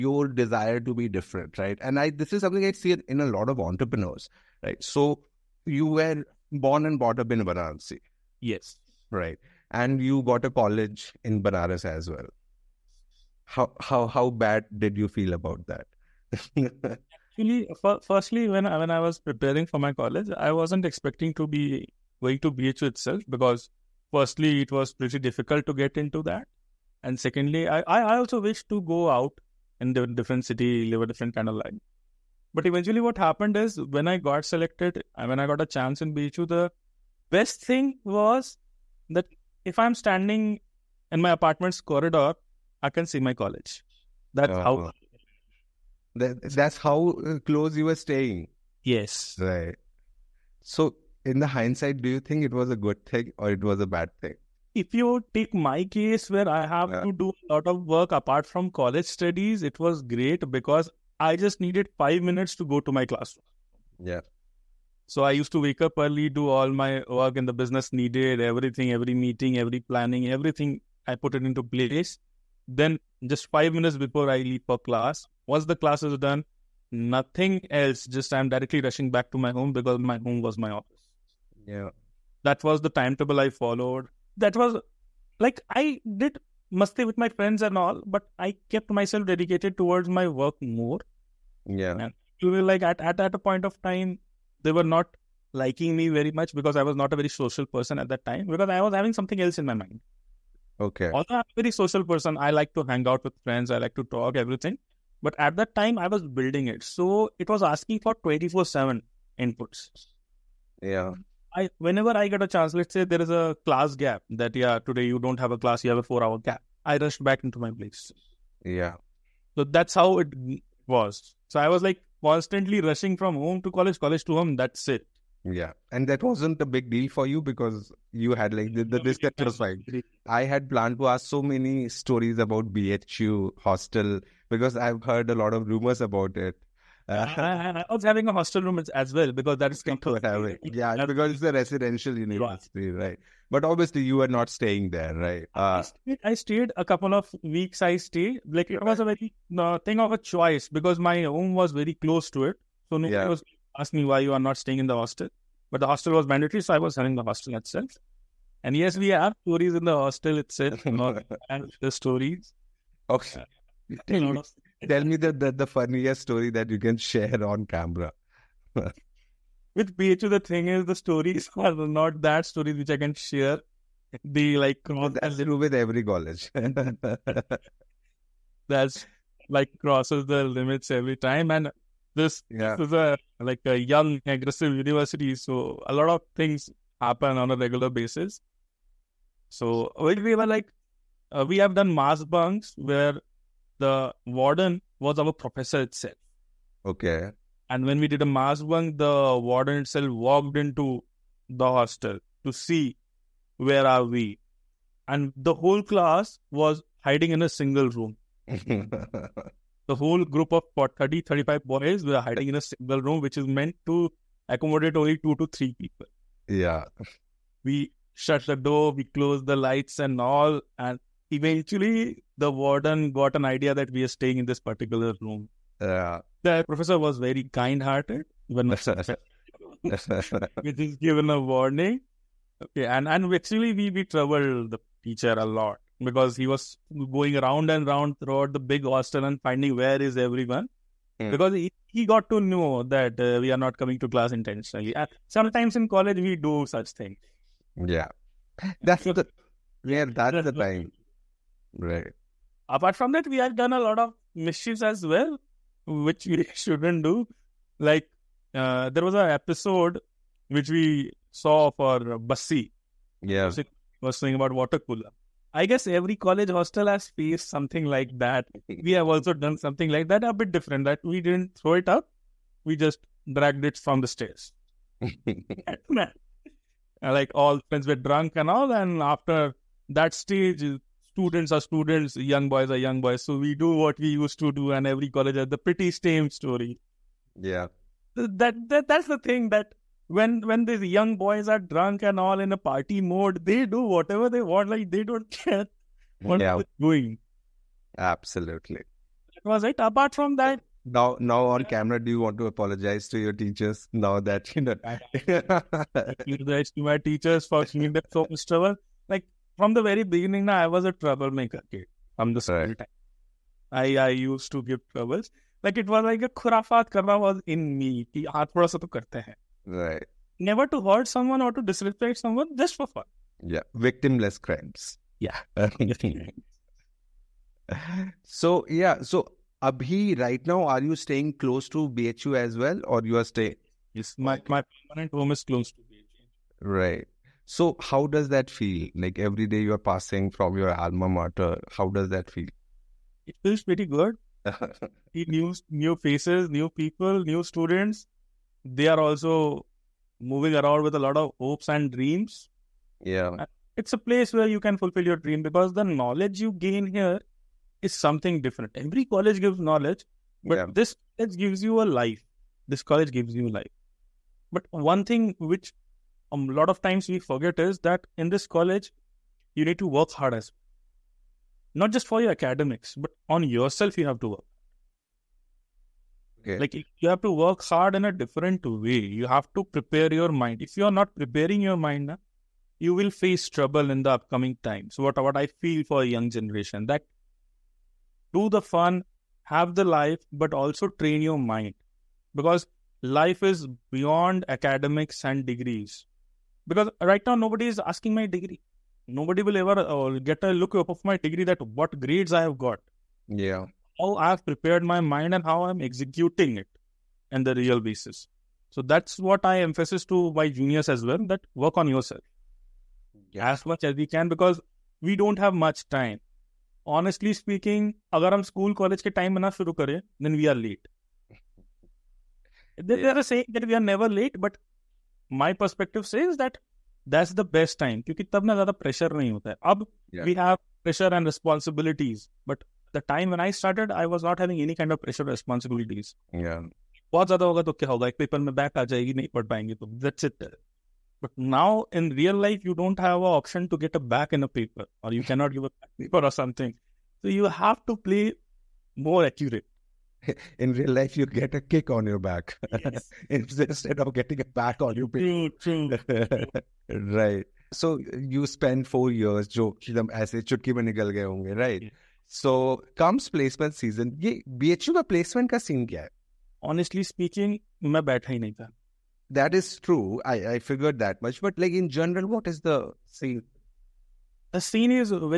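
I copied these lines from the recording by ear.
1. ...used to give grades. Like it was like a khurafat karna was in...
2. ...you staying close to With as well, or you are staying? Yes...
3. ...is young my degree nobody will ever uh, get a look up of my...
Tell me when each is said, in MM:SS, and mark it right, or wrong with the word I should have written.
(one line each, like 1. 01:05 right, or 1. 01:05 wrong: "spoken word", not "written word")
1. 05:14 wrong: "troubles", not "grades"
2. 05:30 wrong: "BHU", not "With"
3. 06:37 wrong: "asking", not "young".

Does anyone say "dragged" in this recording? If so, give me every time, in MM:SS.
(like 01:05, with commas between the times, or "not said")
04:33.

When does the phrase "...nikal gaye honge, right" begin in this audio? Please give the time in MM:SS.
07:40.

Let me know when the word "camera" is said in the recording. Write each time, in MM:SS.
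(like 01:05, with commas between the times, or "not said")
02:47, 05:01.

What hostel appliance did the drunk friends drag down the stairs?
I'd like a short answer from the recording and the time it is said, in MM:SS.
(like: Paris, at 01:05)
Water cooler, at 04:24.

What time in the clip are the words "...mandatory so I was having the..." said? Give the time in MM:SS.
02:36.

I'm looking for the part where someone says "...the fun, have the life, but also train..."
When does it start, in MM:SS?
06:28.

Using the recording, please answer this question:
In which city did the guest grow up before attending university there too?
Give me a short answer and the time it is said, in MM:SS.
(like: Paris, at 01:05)
Varanasi, at 00:07.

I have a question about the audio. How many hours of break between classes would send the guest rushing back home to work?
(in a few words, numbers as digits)
4.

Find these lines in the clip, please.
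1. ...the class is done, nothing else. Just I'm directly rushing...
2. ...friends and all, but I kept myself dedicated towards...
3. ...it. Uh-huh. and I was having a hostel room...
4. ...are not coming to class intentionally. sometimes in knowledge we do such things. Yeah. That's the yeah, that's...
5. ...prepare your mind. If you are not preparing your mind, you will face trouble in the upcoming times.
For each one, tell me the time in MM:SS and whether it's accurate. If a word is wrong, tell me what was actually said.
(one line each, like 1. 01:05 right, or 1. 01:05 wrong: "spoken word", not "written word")
1. 01:15 right
2. 01:27 right
3. 02:16 right
4. 04:03 wrong: "college", not "knowledge"
5. 06:19 right.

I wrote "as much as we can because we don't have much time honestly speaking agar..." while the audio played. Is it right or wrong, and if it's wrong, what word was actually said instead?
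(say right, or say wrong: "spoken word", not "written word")
right.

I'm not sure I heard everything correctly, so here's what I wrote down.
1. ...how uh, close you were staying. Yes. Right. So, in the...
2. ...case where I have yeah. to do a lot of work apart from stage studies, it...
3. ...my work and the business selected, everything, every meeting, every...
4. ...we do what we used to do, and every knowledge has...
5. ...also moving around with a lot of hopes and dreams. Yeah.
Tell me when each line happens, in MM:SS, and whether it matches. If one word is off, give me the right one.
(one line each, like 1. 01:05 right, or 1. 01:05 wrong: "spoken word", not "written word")
1. 00:46 right
2. 00:55 wrong: "college", not "stage"
3. 01:06 wrong: "needed", not "selected"
4. 04:43 wrong: "college", not "knowledge"
5. 05:48 right.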